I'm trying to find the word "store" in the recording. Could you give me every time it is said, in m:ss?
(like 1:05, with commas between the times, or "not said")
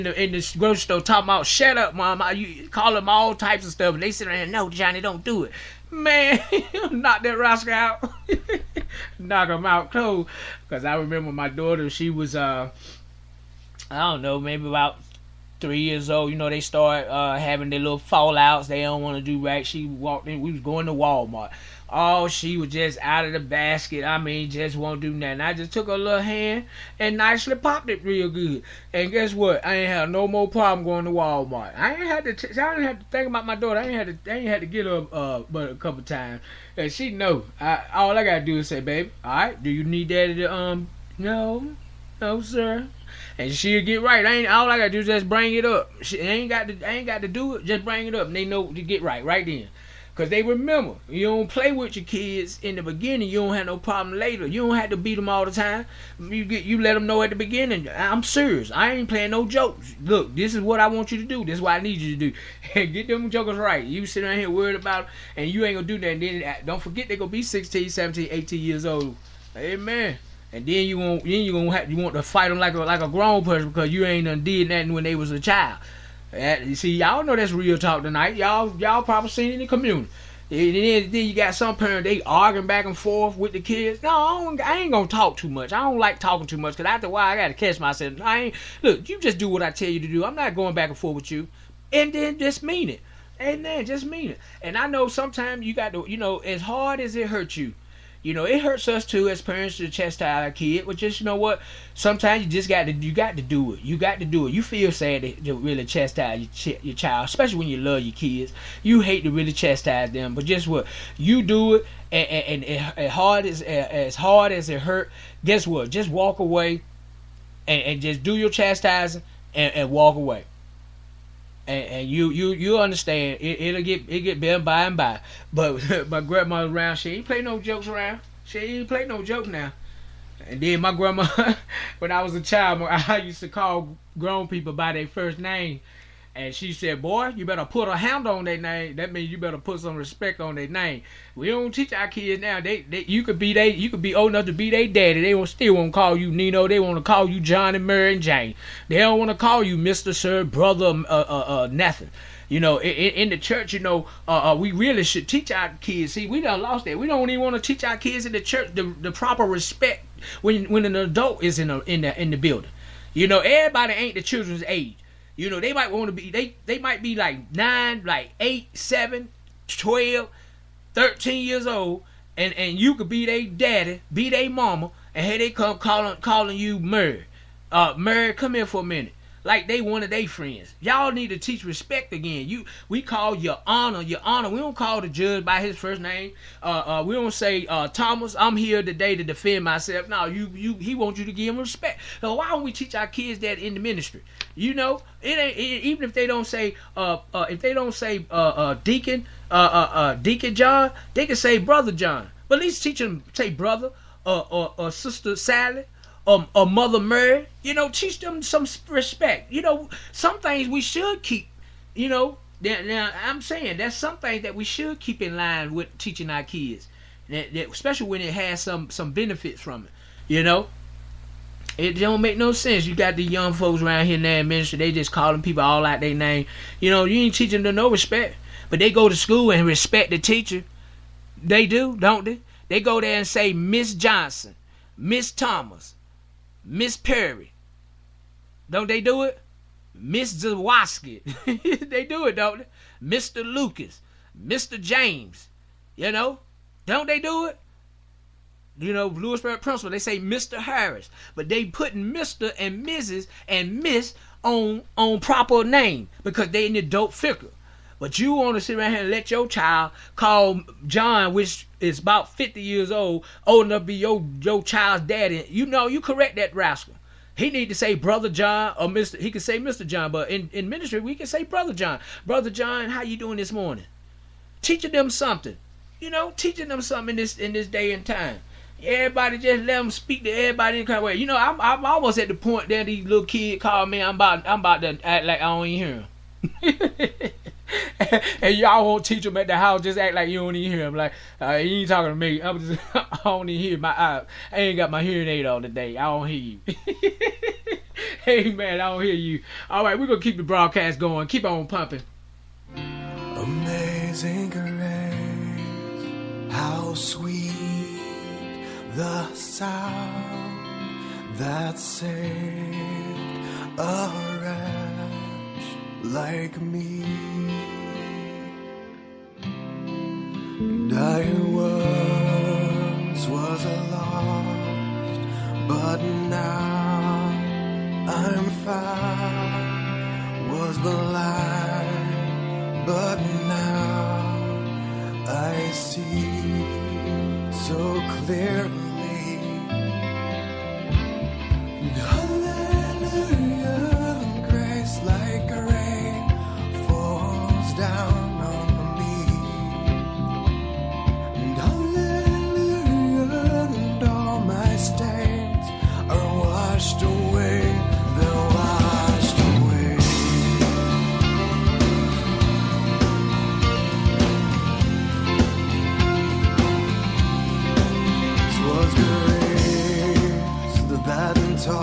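0:00.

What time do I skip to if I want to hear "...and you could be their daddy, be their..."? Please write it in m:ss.
2:52.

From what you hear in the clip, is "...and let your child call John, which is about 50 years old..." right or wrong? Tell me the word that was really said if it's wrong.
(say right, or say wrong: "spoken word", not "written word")
right.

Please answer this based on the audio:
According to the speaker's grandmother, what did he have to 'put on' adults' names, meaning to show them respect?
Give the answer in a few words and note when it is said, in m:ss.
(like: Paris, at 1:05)
a hound, at 2:17.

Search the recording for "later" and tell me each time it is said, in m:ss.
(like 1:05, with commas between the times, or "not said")
0:54.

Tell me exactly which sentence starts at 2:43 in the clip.
You know, everybody ain't the children's age.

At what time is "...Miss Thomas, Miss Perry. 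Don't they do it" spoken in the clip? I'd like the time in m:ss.
3:54.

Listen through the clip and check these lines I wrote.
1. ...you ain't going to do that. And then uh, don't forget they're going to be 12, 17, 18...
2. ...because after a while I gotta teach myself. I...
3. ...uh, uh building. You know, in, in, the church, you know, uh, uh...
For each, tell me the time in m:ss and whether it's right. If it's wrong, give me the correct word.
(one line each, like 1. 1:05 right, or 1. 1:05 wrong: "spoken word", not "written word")
1. 1:05 wrong: "16", not "12"
2. 1:26 wrong: "catch", not "teach"
3. 2:31 wrong: "nothing", not "building".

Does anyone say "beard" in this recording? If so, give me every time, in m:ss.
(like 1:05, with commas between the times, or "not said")
not said.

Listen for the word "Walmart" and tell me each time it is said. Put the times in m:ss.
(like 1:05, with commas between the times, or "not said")
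0:20, 0:31.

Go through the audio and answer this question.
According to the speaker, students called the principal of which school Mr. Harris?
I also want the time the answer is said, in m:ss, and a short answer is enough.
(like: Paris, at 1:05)
Louisburg, at 4:09.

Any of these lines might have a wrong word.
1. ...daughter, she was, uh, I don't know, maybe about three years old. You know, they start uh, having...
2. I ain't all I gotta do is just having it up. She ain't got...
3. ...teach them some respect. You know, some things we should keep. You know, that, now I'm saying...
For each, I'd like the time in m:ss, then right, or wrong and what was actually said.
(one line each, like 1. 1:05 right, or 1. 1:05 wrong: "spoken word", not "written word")
1. 0:11 right
2. 0:44 wrong: "bring", not "having"
3. 3:27 right.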